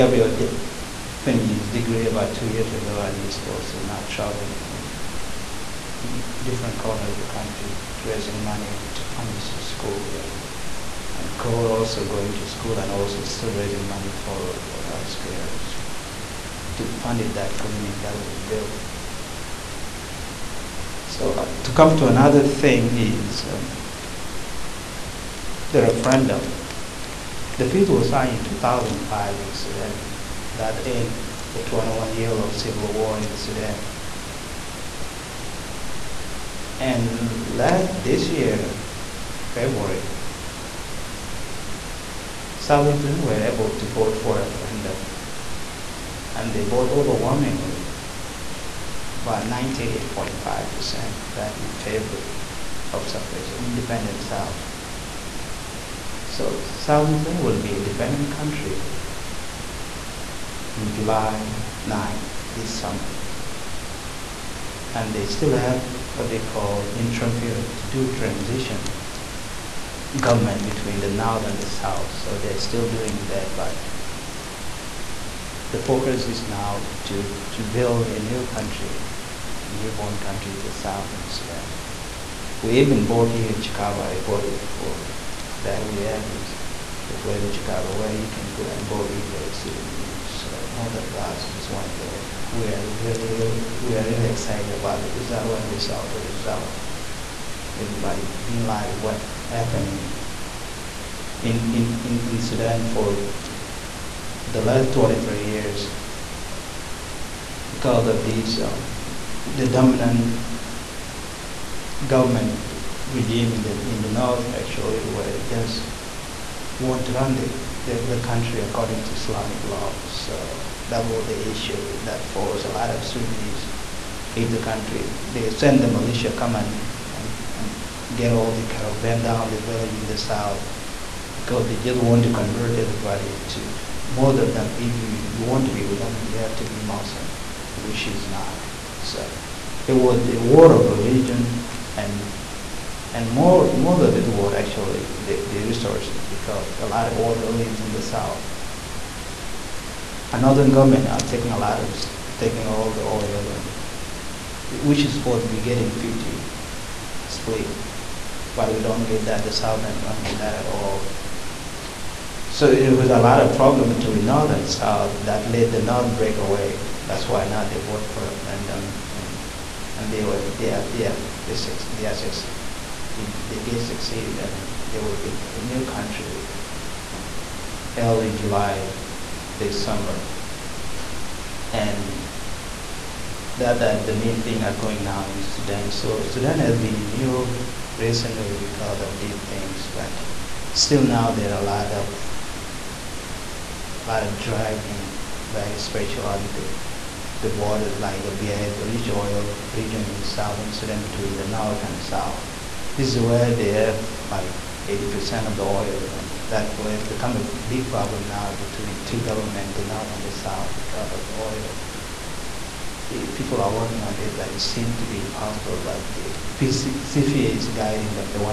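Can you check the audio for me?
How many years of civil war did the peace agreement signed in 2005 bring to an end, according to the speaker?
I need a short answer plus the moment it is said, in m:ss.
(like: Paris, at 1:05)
21, at 0:31.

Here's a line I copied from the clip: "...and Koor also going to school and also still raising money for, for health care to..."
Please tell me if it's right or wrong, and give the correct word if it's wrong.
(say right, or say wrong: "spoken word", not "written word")
right.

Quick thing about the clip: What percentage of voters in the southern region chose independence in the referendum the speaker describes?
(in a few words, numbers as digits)
98.5%.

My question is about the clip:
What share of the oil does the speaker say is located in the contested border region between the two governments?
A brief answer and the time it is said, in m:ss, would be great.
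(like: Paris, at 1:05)
80%, at 3:24.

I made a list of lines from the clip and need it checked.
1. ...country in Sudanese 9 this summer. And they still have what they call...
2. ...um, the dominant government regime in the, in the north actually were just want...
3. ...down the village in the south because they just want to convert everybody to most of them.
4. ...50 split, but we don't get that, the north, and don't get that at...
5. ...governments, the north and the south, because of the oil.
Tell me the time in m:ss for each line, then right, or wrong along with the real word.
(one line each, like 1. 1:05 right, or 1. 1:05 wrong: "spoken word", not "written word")
1. 0:58 wrong: "July", not "Sudanese"
2. 1:48 right
3. 2:09 right
4. 2:35 wrong: "south", not "north"
5. 3:29 right.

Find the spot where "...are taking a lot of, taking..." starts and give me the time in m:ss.
2:31.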